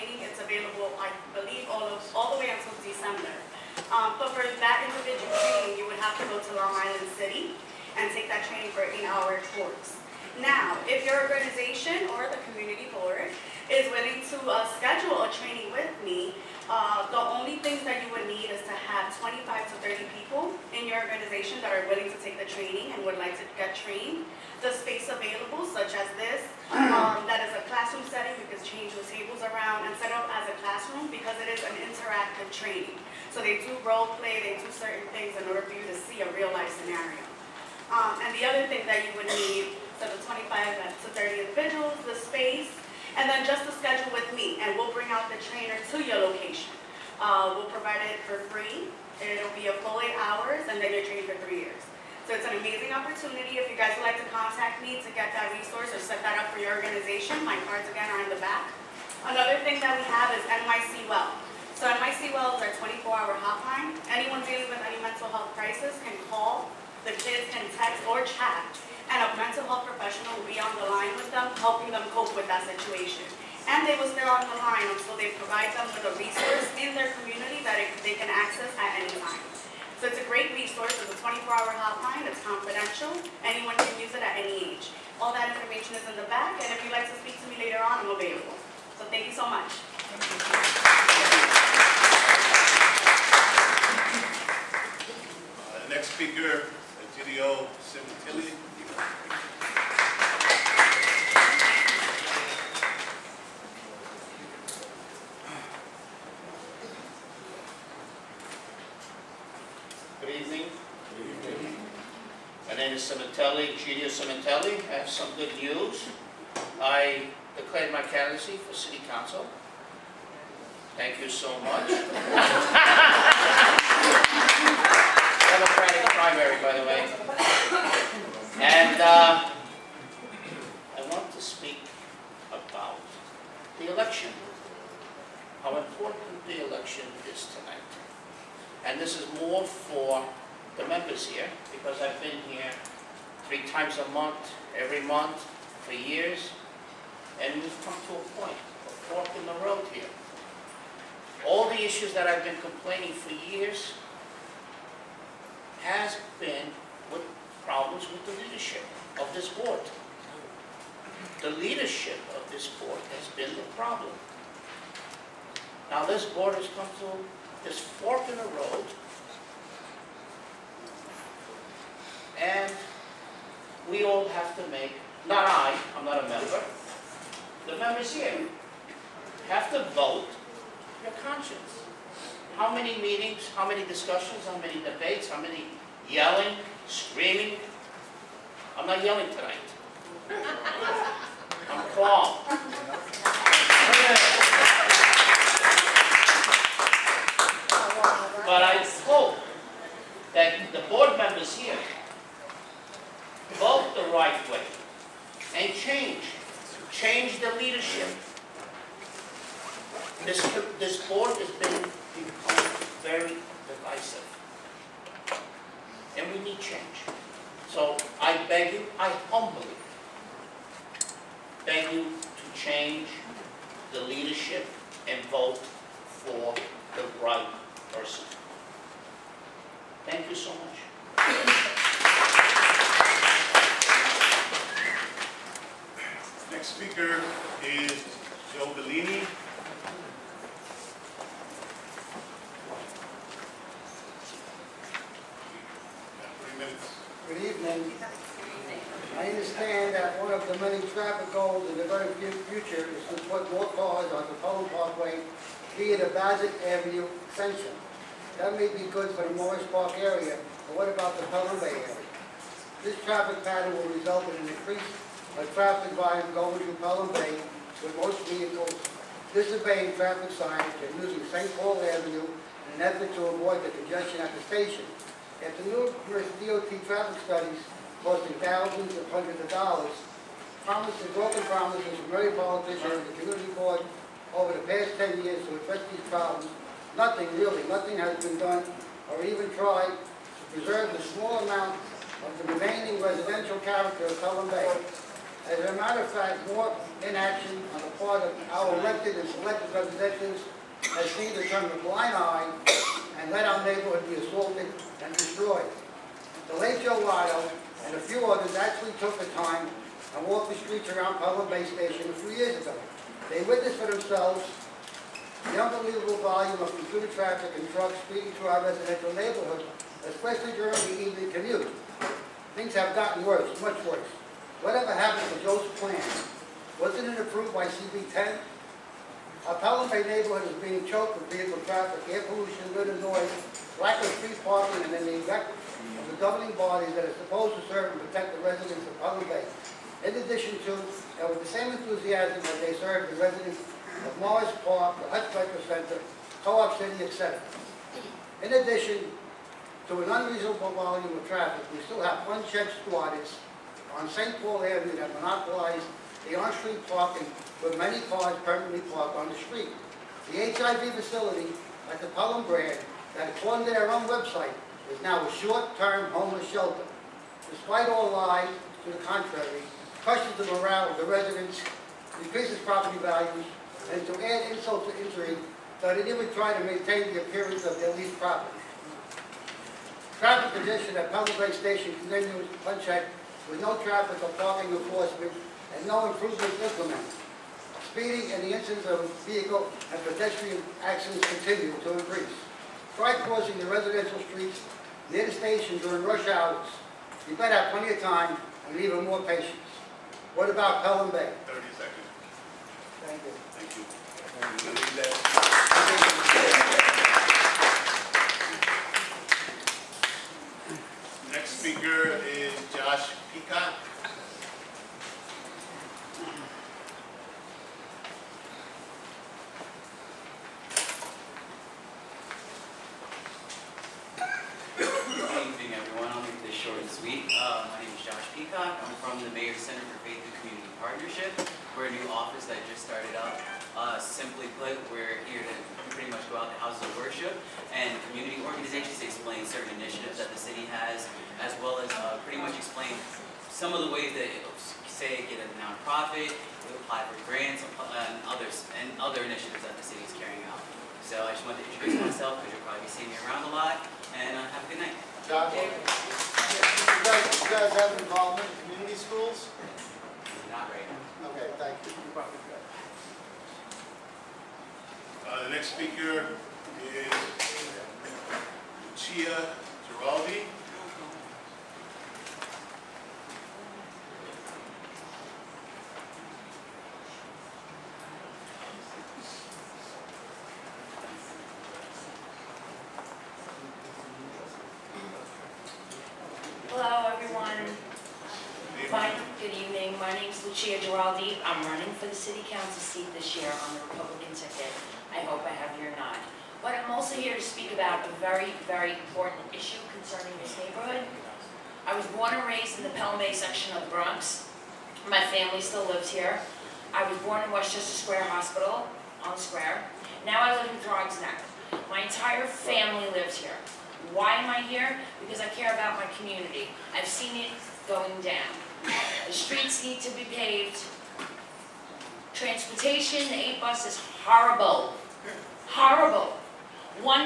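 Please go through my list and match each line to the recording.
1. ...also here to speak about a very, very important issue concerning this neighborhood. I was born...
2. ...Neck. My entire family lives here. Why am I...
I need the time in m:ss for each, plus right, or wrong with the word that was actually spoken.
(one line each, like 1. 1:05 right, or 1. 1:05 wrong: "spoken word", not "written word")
1. 8:16 right
2. 8:31 right.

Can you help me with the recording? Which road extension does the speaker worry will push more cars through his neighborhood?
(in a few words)
Bassett Avenue extension.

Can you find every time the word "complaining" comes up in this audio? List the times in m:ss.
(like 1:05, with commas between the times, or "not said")
2:32.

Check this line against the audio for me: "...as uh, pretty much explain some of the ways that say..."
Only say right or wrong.
right.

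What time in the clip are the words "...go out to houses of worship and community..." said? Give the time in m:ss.
7:16.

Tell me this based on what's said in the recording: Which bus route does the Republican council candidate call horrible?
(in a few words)
8 bus.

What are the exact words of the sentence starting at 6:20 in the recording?
Traffic condition at Pelican Station continues unchecked with no traffic or parking enforcement and no improvements implemented.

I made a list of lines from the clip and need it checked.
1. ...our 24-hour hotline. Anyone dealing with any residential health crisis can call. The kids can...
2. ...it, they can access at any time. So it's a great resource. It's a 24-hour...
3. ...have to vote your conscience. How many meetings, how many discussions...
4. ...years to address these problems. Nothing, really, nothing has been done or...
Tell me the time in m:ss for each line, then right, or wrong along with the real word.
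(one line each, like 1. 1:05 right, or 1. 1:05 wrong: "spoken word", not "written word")
1. 1:02 wrong: "mental", not "residential"
2. 1:17 right
3. 2:59 right
4. 4:45 right.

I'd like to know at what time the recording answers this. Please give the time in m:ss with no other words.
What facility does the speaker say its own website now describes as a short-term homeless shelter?
6:02.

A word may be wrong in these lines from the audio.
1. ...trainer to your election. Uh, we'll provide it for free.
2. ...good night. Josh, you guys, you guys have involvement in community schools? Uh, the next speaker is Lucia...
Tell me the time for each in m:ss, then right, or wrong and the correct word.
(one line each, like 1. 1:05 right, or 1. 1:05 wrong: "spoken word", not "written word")
1. 0:45 wrong: "location", not "election"
2. 7:34 right.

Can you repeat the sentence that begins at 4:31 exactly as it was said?
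Paul Avenue in an effort to avoid the congestion at the station.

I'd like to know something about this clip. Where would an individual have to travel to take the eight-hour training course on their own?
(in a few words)
Long Island City.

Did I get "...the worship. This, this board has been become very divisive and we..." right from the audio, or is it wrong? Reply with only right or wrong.
wrong.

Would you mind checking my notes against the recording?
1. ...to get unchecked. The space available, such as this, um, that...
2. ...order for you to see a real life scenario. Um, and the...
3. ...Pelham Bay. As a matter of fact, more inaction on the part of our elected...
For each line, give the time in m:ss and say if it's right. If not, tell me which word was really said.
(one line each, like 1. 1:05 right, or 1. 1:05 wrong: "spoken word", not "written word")
1. 0:23 wrong: "trained", not "unchecked"
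2. 0:35 right
3. 4:54 right.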